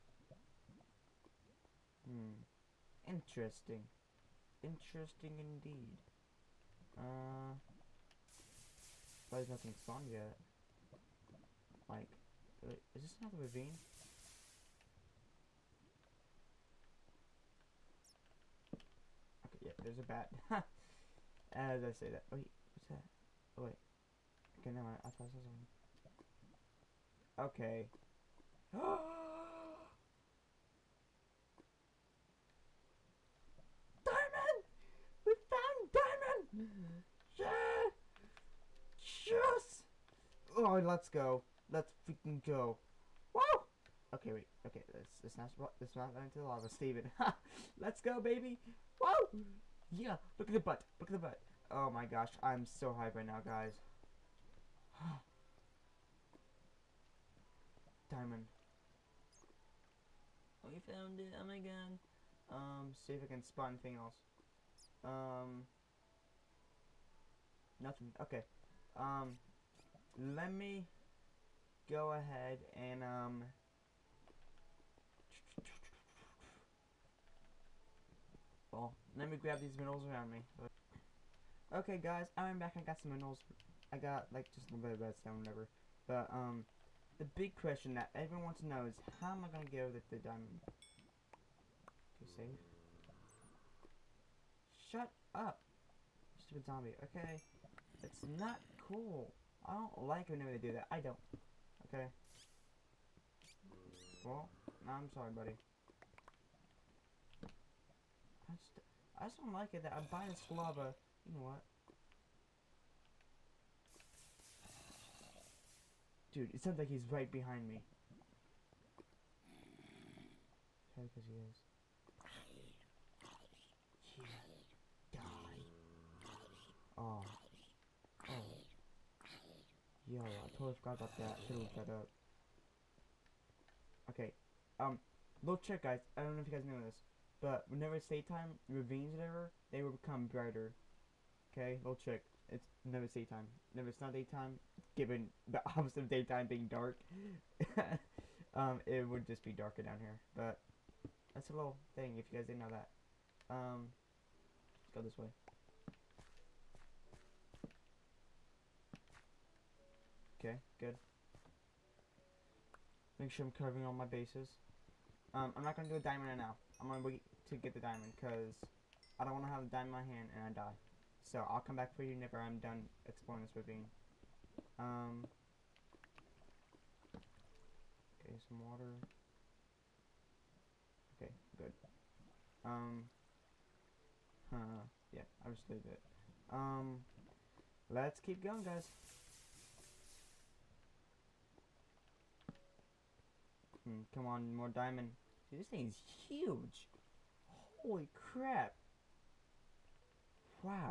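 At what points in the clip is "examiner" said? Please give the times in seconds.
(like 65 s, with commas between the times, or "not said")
not said.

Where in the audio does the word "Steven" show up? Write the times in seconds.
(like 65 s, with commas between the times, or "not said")
46 s.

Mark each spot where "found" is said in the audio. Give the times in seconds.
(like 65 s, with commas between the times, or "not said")
35 s, 60 s.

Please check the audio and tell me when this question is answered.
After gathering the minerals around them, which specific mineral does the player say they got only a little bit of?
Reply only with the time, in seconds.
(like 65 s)
84 s.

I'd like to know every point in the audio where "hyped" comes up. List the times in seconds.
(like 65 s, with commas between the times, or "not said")
52 s.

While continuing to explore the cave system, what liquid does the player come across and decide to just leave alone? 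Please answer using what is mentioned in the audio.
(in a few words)
Water.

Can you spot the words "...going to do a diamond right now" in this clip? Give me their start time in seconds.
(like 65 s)
165 s.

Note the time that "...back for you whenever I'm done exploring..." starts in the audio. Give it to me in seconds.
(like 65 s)
171 s.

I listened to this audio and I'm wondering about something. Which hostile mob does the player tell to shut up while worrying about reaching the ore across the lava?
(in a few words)
Zombie.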